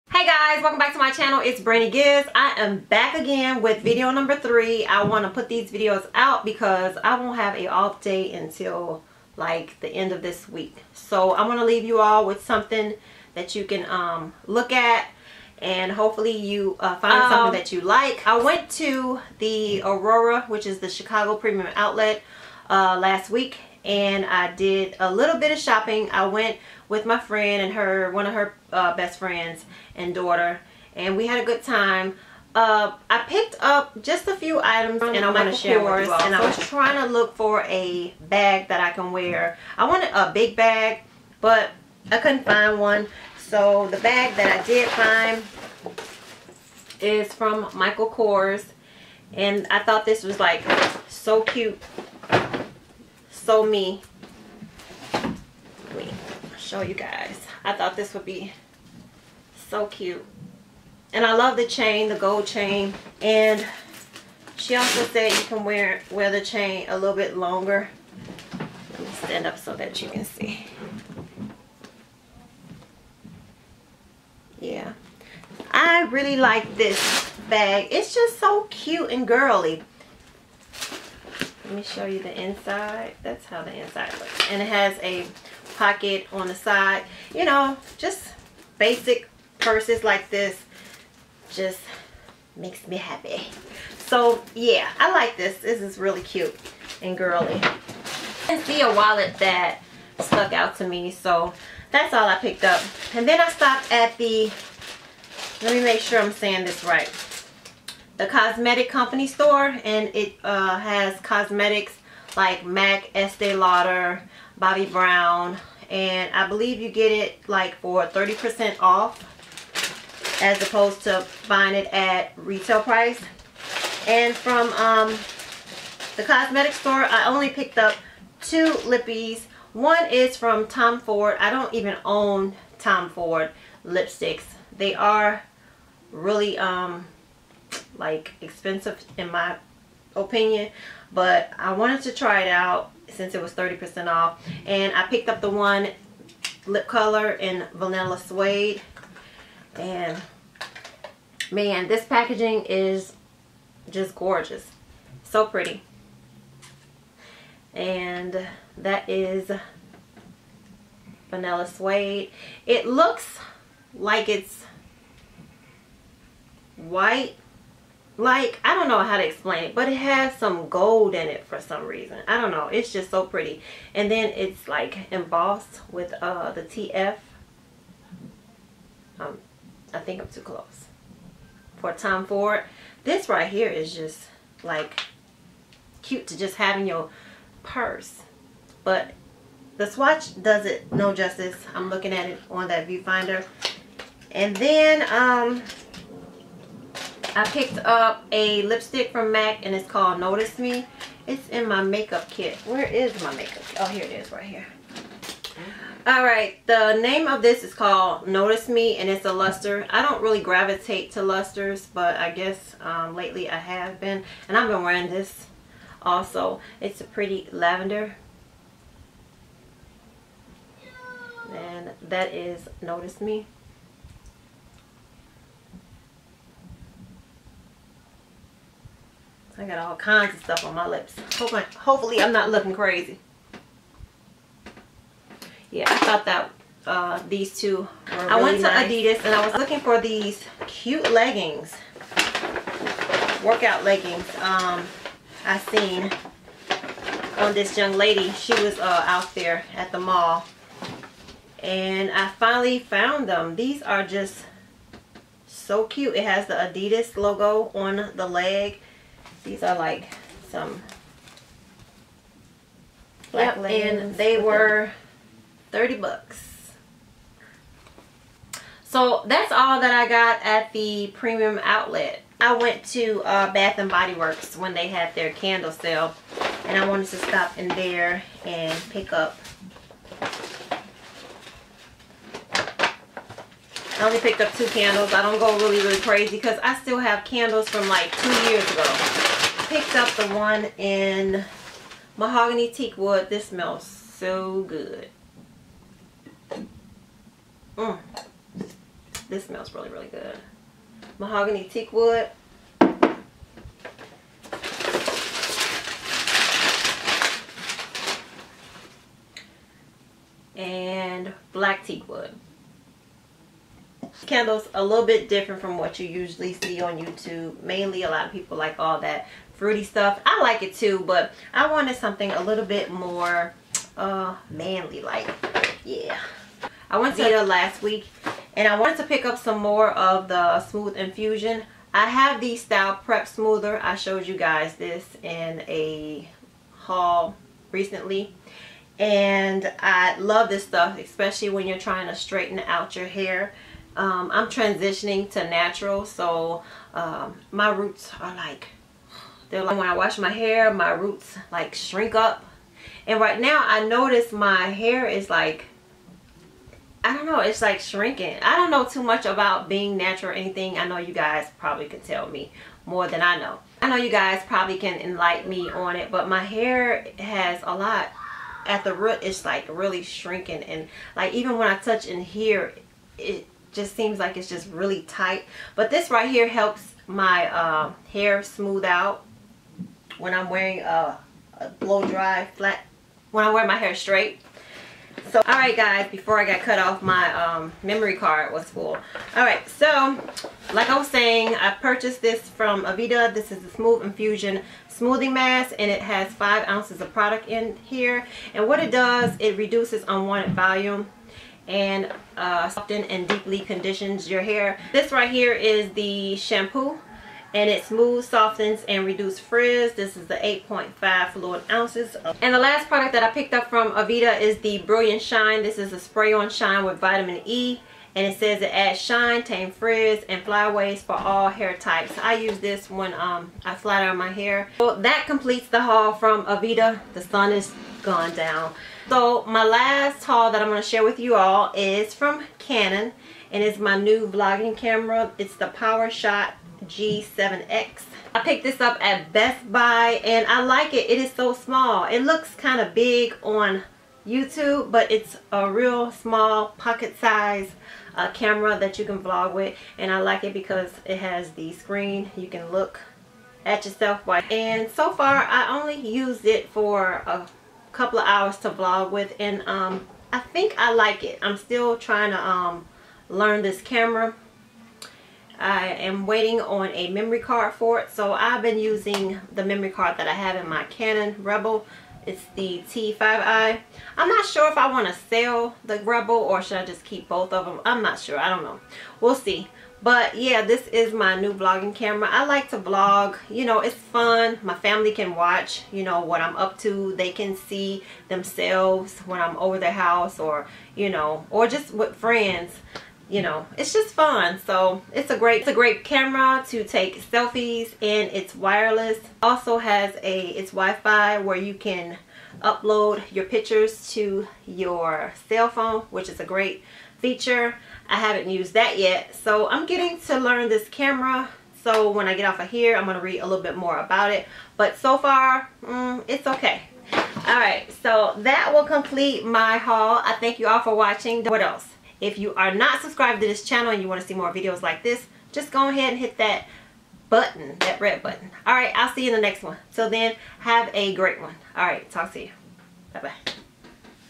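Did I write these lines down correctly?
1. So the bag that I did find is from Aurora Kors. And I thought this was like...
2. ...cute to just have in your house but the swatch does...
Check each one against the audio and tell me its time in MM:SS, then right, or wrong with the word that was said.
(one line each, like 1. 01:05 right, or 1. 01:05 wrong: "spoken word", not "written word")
1. 00:43 wrong: "Michael", not "Aurora"
2. 03:06 wrong: "purse", not "house".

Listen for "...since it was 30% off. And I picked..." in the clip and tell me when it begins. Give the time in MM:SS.
02:23.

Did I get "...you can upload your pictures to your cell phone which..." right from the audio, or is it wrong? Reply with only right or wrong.
right.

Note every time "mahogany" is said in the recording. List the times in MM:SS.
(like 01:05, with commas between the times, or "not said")
04:52, 05:01.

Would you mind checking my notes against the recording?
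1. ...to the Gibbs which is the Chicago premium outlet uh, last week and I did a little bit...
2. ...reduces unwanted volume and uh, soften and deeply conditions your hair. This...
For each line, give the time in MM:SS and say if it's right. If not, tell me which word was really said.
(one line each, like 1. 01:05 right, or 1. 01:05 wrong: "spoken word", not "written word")
1. 00:18 wrong: "Aurora", not "Gibbs"
2. 06:39 right.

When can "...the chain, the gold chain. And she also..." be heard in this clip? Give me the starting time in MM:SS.
01:01.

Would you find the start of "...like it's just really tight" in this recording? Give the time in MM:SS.
06:14.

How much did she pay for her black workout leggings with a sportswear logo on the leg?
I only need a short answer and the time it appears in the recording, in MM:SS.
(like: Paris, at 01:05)
$30, at 04:25.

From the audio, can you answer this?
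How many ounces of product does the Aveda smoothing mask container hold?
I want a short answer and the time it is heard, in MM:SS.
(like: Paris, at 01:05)
5 ounces, at 06:36.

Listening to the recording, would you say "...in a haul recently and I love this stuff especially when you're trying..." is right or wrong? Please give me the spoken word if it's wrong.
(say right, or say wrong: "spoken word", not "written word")
right.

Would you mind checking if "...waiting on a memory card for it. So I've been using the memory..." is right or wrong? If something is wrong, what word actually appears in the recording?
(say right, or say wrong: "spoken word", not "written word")
right.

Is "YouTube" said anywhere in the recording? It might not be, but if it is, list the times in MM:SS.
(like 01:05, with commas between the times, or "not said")
05:16, 07:24.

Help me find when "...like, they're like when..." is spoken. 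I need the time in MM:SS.
05:48.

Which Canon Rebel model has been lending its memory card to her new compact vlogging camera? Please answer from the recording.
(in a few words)
T5i.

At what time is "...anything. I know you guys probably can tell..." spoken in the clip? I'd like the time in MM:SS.
06:00.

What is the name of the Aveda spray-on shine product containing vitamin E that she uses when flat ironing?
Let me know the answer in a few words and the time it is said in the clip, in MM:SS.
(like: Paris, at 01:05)
Brilliant Shine, at 06:54.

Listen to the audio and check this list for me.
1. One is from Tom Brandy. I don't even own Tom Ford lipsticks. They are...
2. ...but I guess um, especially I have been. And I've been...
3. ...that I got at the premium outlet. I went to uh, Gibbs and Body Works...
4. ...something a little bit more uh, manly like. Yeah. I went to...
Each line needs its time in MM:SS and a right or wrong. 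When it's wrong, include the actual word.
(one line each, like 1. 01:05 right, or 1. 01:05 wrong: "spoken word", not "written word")
1. 02:09 wrong: "Ford", not "Brandy"
2. 03:31 wrong: "lately", not "especially"
3. 04:29 wrong: "Bath", not "Gibbs"
4. 05:21 right.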